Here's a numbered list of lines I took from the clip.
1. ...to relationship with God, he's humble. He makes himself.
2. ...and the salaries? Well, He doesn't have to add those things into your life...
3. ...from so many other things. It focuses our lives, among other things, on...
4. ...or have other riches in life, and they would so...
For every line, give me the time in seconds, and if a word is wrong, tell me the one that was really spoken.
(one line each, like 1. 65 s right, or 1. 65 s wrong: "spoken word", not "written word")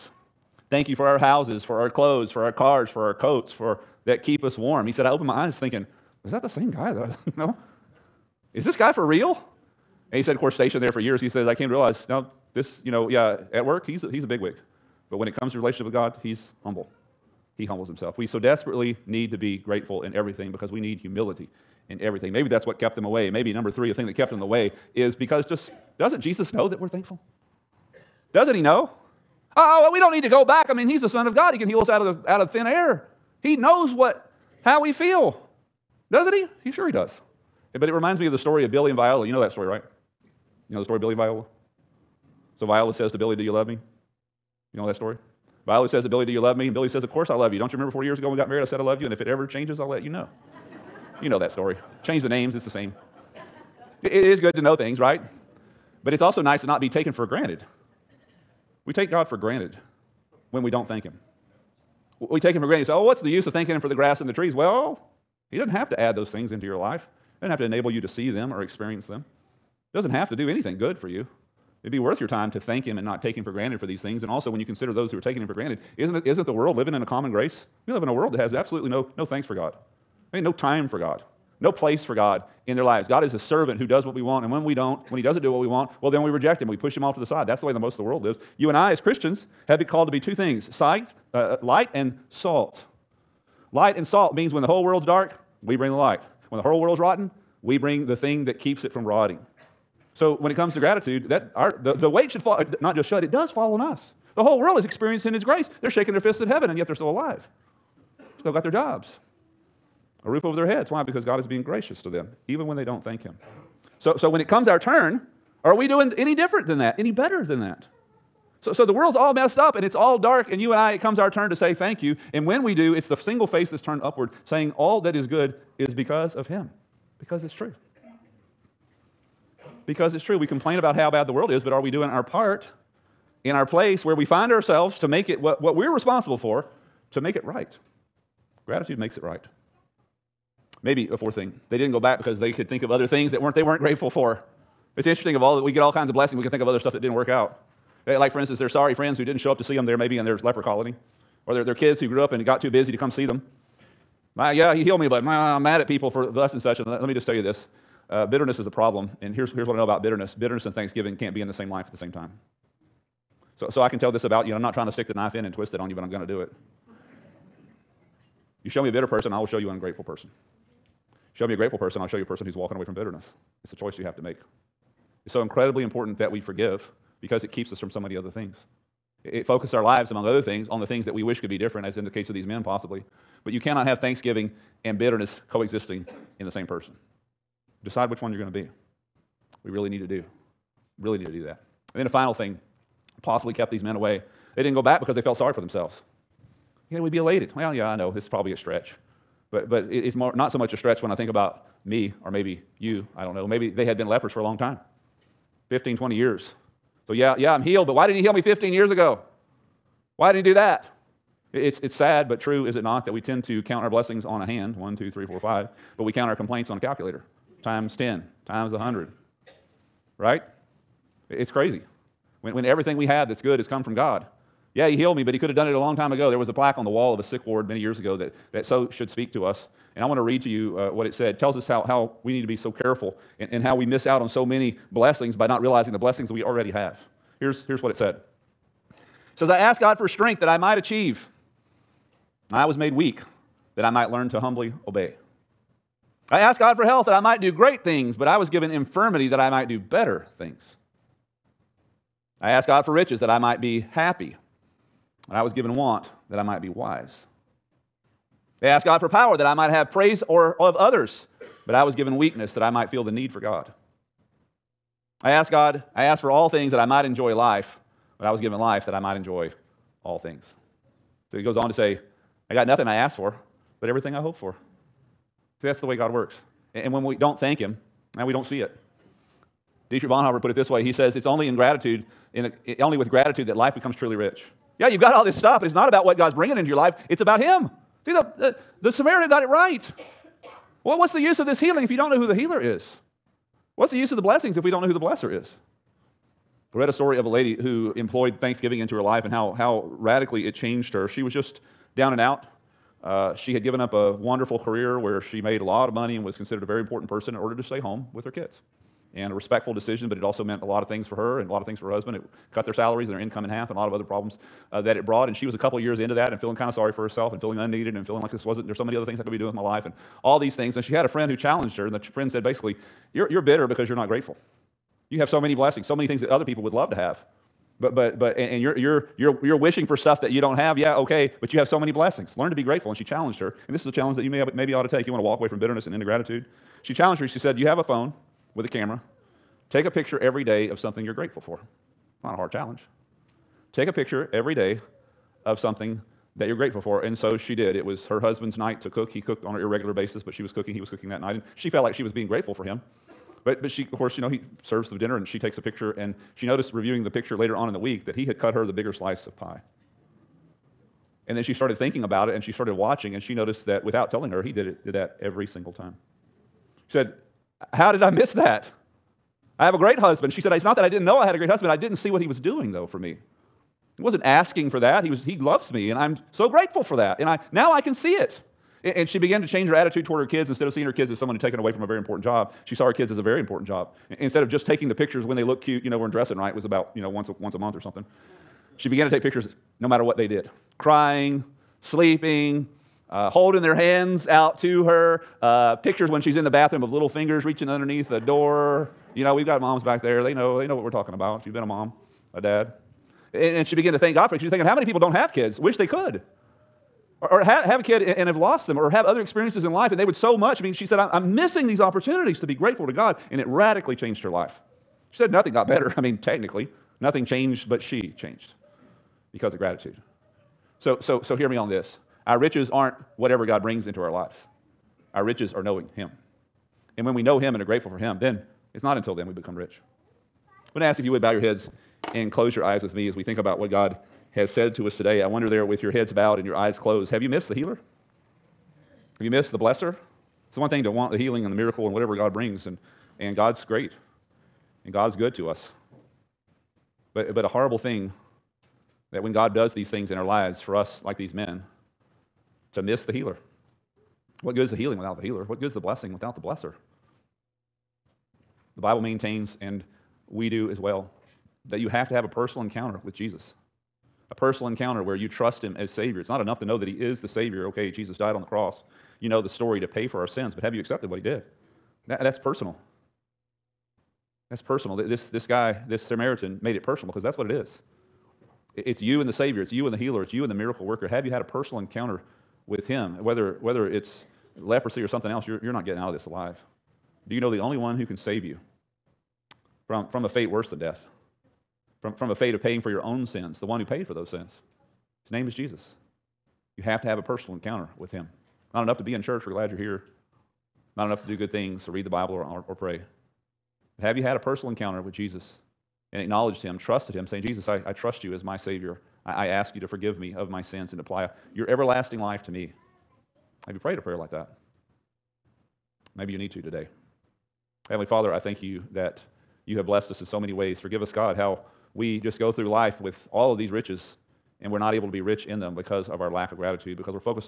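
1. 15 s wrong: "humbles", not "makes"
2. 64 s wrong: "trees", not "salaries"
3. 177 s right
4. 408 s wrong: "experiences", not "riches".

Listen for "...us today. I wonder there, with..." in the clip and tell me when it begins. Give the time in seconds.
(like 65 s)
434 s.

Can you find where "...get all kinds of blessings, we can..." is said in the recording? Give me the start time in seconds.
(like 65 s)
145 s.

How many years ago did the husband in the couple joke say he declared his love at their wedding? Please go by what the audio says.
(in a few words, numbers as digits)
40.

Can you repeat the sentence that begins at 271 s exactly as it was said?
So he goes on to say, I got nothing I asked for, but everything I hoped for.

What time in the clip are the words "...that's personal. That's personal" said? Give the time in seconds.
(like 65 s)
472 s.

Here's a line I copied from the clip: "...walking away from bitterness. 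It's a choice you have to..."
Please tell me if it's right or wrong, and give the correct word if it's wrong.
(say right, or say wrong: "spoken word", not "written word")
right.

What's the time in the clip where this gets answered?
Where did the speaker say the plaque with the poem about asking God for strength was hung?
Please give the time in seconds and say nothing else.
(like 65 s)
227 s.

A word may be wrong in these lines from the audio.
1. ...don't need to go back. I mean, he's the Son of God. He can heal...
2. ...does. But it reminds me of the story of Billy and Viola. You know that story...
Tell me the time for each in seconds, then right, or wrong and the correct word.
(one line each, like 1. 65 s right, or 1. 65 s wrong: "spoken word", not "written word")
1. 29 s right
2. 36 s right.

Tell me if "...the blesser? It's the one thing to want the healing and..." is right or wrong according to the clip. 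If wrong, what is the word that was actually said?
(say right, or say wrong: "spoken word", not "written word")
right.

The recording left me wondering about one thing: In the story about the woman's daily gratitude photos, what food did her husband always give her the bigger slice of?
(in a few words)
Pie.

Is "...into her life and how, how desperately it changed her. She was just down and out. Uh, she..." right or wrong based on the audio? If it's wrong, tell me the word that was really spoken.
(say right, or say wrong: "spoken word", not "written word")
wrong: "radically", not "desperately".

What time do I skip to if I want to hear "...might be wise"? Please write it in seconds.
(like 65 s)
256 s.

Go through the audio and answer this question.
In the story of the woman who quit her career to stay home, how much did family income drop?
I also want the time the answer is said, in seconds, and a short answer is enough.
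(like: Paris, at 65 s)
In half, at 313 s.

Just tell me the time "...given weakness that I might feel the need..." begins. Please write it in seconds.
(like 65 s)
261 s.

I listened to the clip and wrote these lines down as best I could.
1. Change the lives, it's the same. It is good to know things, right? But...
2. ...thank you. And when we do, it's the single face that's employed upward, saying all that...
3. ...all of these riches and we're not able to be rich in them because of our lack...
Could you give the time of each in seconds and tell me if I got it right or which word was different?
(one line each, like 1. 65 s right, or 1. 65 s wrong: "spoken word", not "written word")
1. 52 s wrong: "names", not "lives"
2. 121 s wrong: "turned", not "employed"
3. 523 s right.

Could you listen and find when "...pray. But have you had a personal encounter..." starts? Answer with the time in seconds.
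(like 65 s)
502 s.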